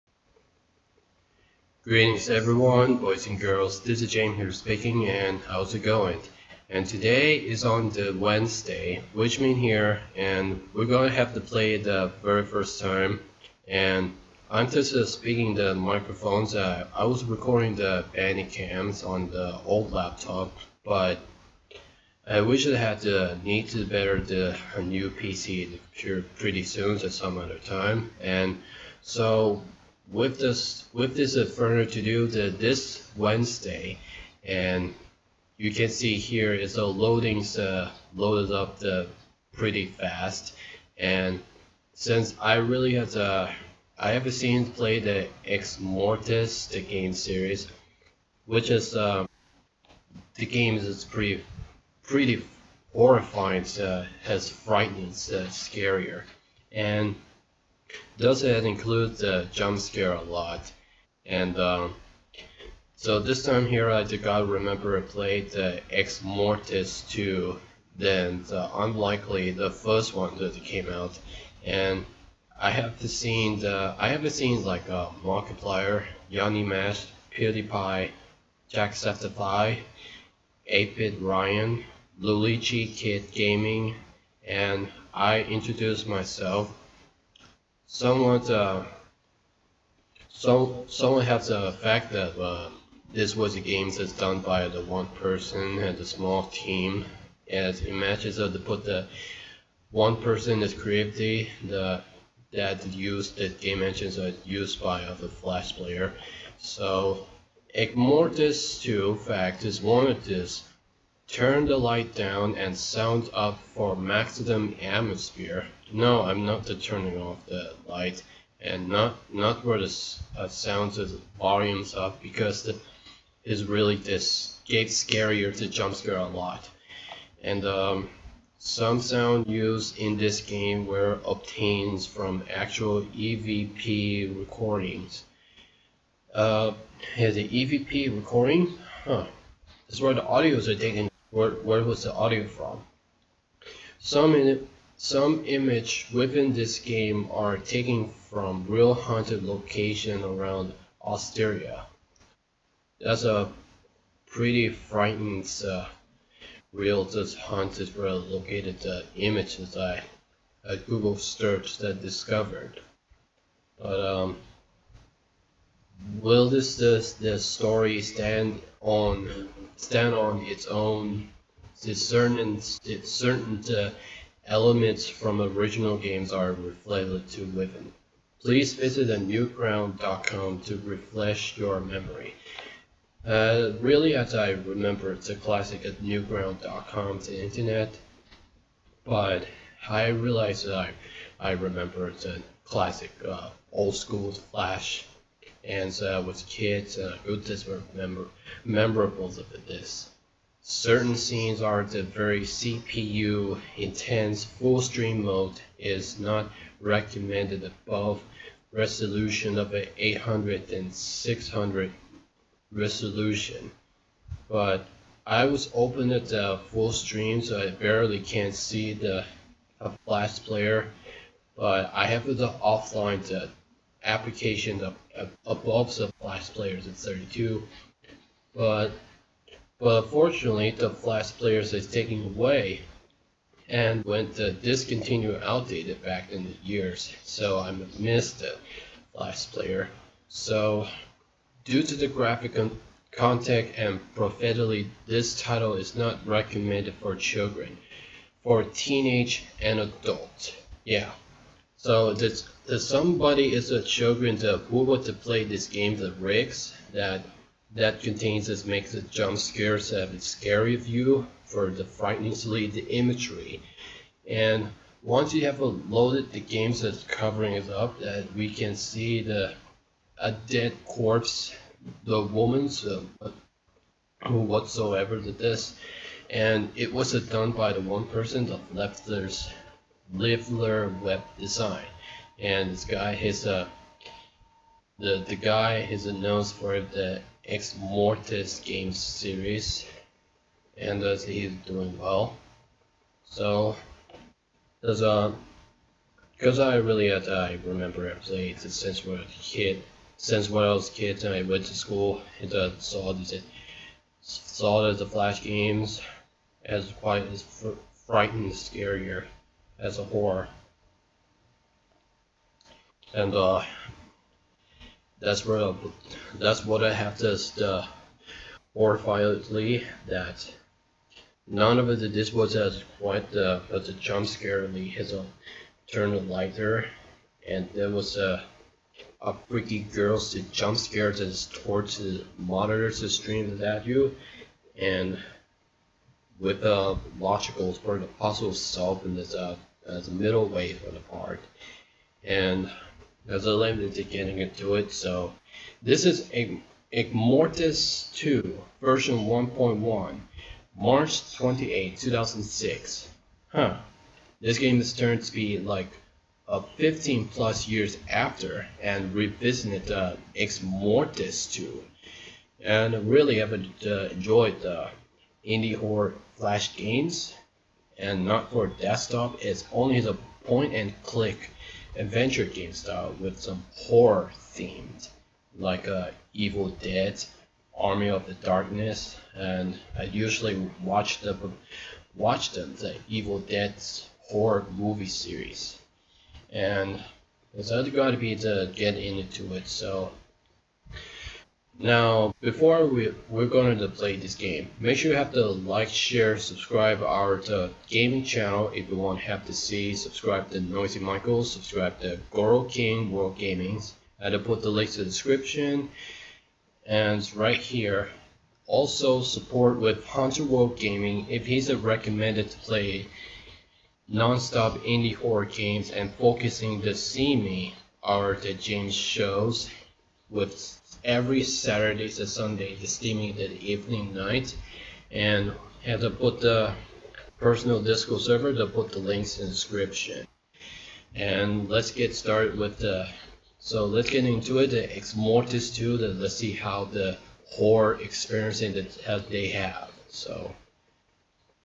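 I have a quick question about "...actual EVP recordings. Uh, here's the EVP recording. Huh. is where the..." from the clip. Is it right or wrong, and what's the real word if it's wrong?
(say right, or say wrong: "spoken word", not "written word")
right.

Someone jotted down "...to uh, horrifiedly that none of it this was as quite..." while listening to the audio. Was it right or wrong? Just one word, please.
right.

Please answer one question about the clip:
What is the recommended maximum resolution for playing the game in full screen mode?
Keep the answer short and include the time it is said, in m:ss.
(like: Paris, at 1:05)
800 by 600, at 3:30.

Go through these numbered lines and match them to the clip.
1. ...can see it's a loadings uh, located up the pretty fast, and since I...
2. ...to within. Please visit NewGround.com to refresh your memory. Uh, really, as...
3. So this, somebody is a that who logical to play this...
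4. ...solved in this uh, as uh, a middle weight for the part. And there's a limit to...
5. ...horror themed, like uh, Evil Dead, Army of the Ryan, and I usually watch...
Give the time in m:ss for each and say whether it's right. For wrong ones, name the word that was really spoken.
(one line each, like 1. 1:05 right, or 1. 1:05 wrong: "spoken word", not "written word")
1. 0:35 wrong: "loaded", not "located"
2. 2:57 right
3. 4:11 wrong: "approval", not "logical"
4. 5:38 right
5. 6:13 wrong: "Darkness", not "Ryan".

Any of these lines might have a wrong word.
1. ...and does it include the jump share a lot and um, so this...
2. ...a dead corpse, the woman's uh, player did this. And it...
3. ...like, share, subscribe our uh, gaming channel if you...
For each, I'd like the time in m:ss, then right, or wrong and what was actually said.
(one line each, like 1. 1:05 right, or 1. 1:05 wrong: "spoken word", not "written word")
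1. 0:56 wrong: "scare", not "share"
2. 4:30 wrong: "whatsoever", not "player"
3. 6:35 right.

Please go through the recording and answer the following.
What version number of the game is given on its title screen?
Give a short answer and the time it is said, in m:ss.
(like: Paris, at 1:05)
1.1, at 5:49.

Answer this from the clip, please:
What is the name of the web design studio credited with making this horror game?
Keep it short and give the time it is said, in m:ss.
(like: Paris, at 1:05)
Leffler web design, at 4:40.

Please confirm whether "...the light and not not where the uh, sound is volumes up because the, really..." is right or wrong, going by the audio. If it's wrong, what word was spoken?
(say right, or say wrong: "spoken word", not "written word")
right.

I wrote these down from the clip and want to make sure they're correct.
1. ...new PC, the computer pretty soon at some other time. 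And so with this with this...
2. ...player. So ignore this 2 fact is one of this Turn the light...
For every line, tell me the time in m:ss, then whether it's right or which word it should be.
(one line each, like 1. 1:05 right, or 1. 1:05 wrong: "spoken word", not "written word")
1. 0:24 right
2. 1:45 right.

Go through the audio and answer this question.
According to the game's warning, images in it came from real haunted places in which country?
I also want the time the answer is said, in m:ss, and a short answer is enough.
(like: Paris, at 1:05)
Austria, at 2:31.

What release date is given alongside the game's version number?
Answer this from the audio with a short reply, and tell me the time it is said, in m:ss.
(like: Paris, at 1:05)
March 28, 2006, at 5:50.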